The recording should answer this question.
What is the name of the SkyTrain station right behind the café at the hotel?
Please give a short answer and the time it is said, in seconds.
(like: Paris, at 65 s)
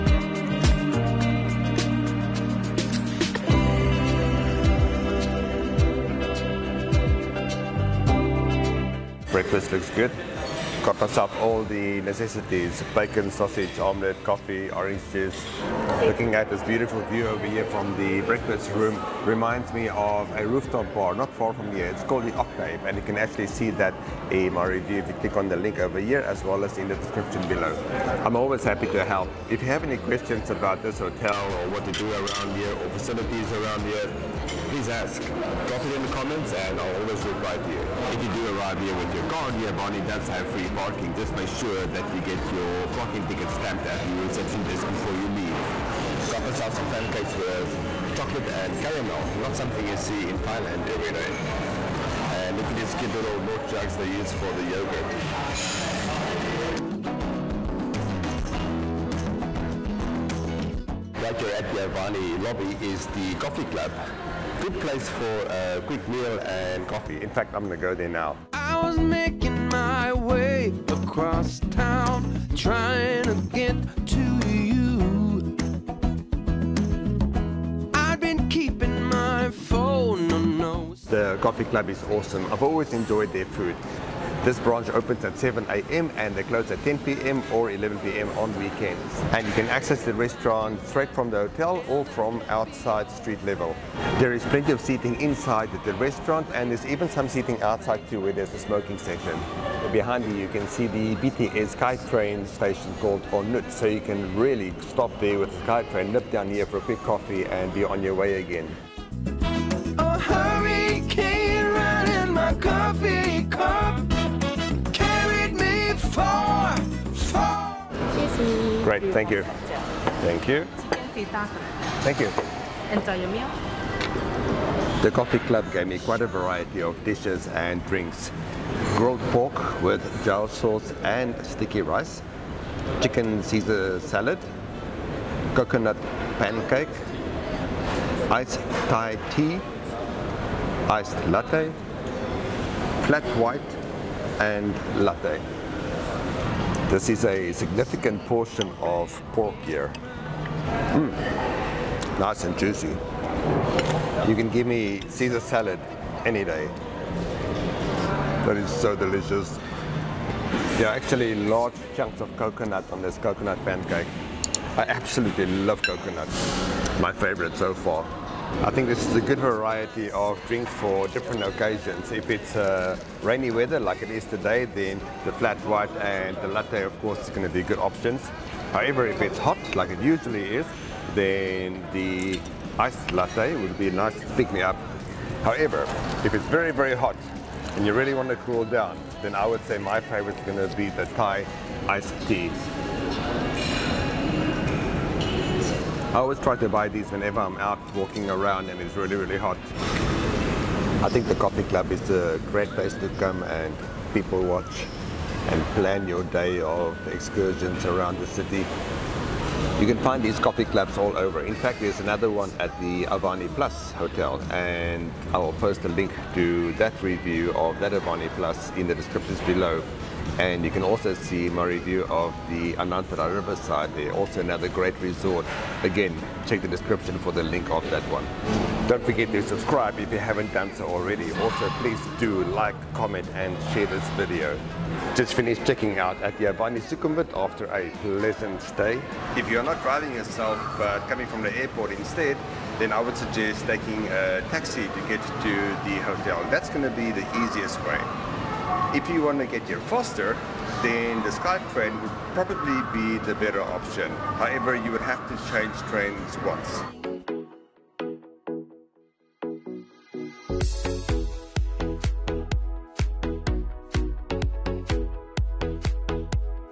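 On Nut, at 103 s.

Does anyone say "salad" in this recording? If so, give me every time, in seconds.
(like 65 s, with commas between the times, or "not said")
134 s, 155 s.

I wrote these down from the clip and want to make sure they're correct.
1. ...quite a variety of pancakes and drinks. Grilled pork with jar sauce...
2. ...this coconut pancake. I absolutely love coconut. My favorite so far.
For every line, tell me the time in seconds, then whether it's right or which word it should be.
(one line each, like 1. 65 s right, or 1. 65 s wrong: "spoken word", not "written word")
1. 125 s wrong: "dishes", not "pancakes"
2. 163 s right.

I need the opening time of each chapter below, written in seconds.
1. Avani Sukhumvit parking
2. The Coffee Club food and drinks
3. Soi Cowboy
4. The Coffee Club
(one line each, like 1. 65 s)
1. 38 s
2. 124 s
3. 257 s
4. 63 s.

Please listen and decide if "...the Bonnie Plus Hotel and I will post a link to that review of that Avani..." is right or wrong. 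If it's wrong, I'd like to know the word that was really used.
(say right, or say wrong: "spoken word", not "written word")
wrong: "Avani", not "Bonnie".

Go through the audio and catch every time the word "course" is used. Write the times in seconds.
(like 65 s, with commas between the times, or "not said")
177 s.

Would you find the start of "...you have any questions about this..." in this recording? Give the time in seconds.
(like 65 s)
29 s.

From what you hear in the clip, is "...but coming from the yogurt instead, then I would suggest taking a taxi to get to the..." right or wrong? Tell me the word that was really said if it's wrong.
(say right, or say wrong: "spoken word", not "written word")
wrong: "airport", not "yogurt".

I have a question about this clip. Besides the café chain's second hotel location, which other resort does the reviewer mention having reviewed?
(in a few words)
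Anantara Riverside.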